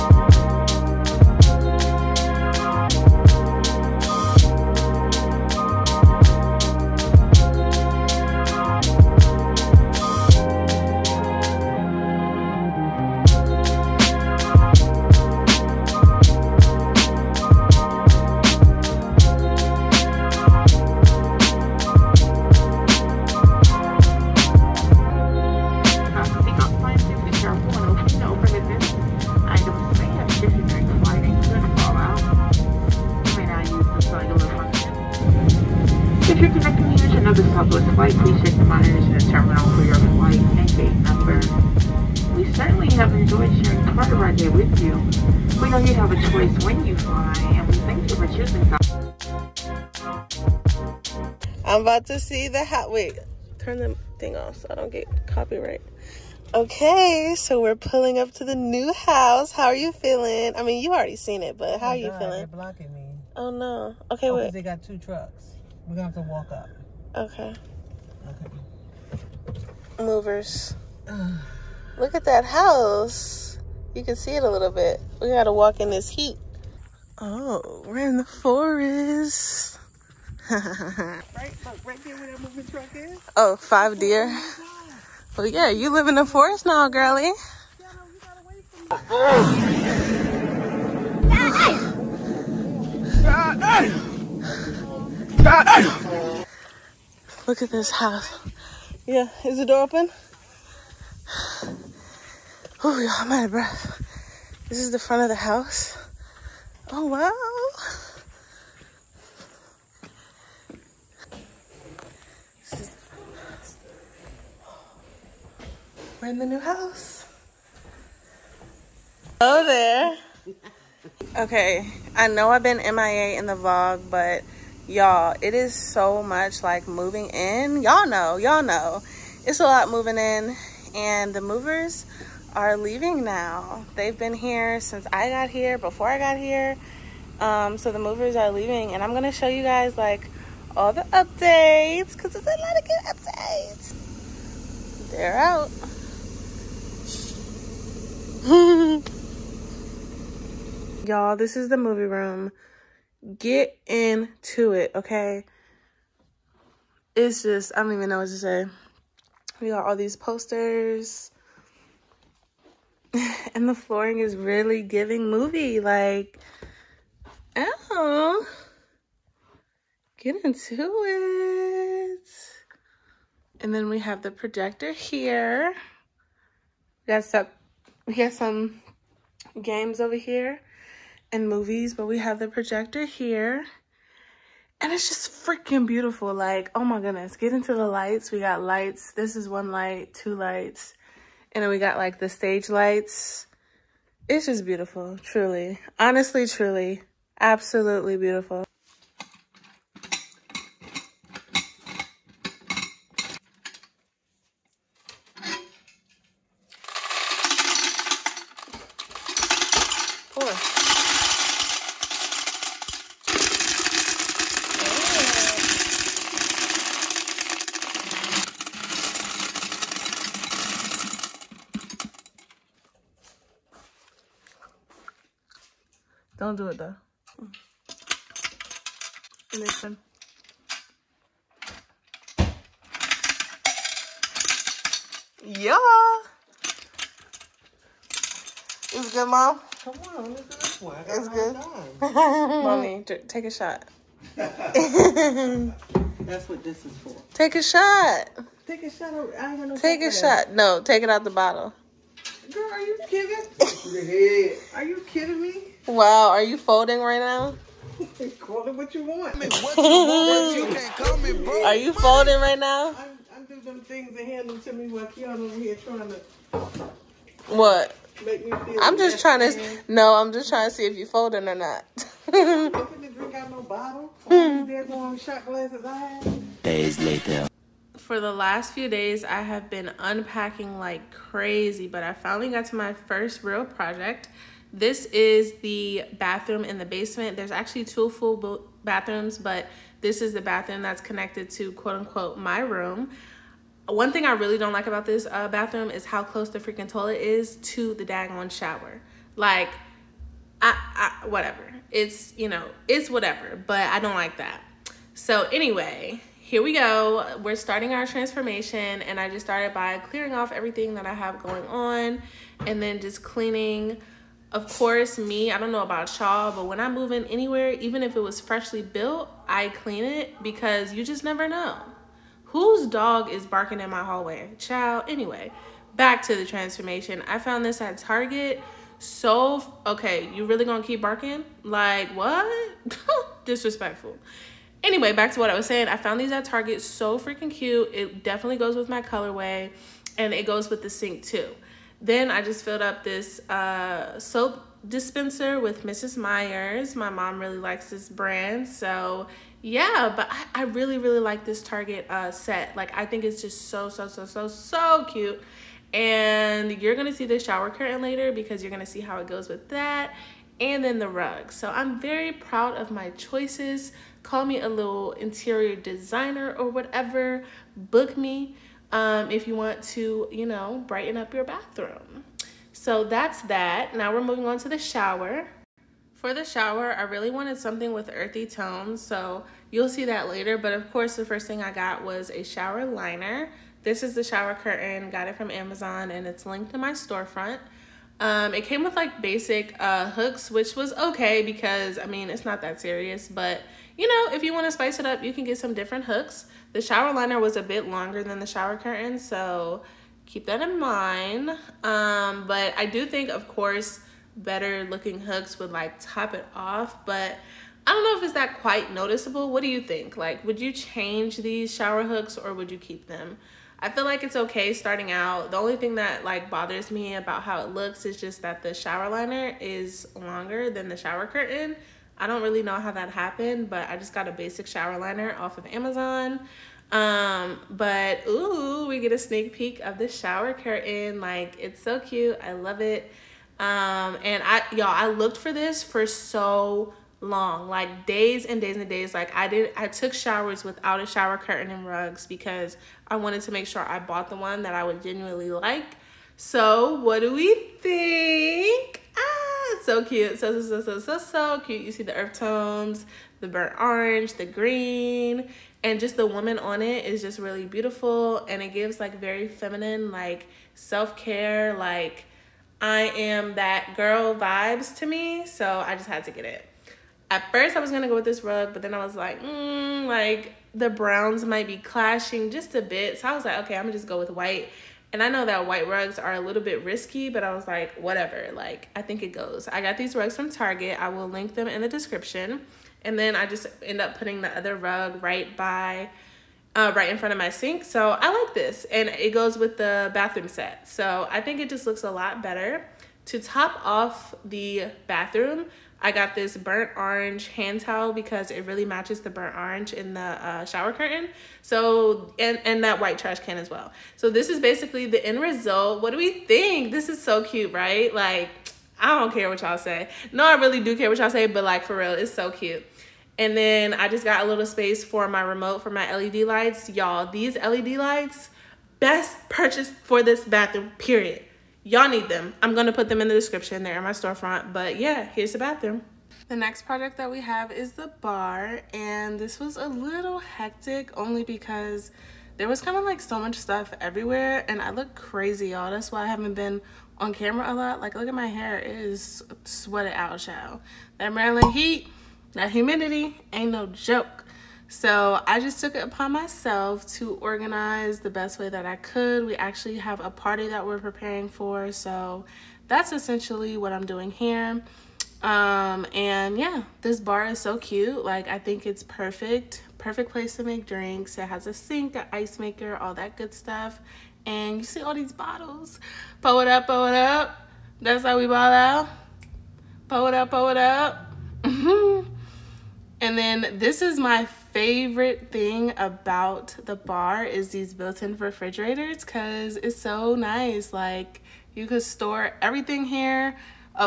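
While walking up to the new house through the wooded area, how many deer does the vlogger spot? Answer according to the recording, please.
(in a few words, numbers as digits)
5.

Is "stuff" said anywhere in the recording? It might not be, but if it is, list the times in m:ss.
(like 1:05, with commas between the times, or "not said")
8:53, 9:23.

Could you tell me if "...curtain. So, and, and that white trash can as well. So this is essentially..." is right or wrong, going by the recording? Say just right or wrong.
wrong.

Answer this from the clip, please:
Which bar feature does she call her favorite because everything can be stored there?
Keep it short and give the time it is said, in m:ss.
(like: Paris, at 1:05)
Built-in refrigerators, at 9:37.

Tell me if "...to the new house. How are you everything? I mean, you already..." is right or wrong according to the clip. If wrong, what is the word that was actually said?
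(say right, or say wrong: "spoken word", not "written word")
wrong: "feeling", not "everything".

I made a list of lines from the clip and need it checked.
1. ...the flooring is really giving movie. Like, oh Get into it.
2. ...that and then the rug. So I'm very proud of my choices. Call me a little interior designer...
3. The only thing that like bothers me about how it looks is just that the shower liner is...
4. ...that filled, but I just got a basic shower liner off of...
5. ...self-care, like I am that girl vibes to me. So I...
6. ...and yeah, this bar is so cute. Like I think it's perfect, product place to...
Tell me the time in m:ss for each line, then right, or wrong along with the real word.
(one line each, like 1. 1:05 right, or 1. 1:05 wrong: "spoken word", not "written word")
1. 2:43 right
2. 5:59 right
3. 6:55 right
4. 7:02 wrong: "happened", not "filled"
5. 7:40 right
6. 9:16 wrong: "perfect", not "product".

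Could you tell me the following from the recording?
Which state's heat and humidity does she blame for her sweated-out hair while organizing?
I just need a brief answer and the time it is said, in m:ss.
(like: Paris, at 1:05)
Maryland, at 9:01.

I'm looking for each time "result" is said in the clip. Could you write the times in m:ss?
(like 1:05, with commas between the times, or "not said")
8:25.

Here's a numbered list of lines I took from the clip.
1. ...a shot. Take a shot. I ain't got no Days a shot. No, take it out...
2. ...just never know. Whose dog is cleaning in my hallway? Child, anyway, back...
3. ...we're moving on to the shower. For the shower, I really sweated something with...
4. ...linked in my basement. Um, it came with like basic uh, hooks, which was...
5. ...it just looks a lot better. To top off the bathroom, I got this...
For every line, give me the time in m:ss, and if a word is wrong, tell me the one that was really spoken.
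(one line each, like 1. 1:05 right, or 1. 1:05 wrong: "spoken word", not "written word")
1. 4:07 wrong: "Take", not "Days"
2. 5:21 wrong: "barking", not "cleaning"
3. 6:14 wrong: "wanted", not "sweated"
4. 6:26 wrong: "storefront", not "basement"
5. 8:11 right.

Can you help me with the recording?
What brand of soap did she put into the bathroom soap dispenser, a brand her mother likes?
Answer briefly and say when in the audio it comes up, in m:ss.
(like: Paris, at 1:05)
Mrs. Meyer's, at 5:45.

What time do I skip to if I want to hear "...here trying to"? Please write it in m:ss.
4:25.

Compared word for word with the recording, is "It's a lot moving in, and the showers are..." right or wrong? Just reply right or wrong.
wrong.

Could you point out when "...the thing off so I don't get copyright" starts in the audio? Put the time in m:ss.
0:53.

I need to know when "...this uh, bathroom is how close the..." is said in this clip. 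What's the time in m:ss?
4:55.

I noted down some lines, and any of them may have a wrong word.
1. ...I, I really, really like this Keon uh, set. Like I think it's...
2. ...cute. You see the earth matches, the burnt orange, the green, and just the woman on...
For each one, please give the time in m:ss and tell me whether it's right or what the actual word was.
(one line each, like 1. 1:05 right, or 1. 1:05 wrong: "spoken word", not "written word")
1. 5:50 wrong: "Target", not "Keon"
2. 7:31 wrong: "tones", not "matches".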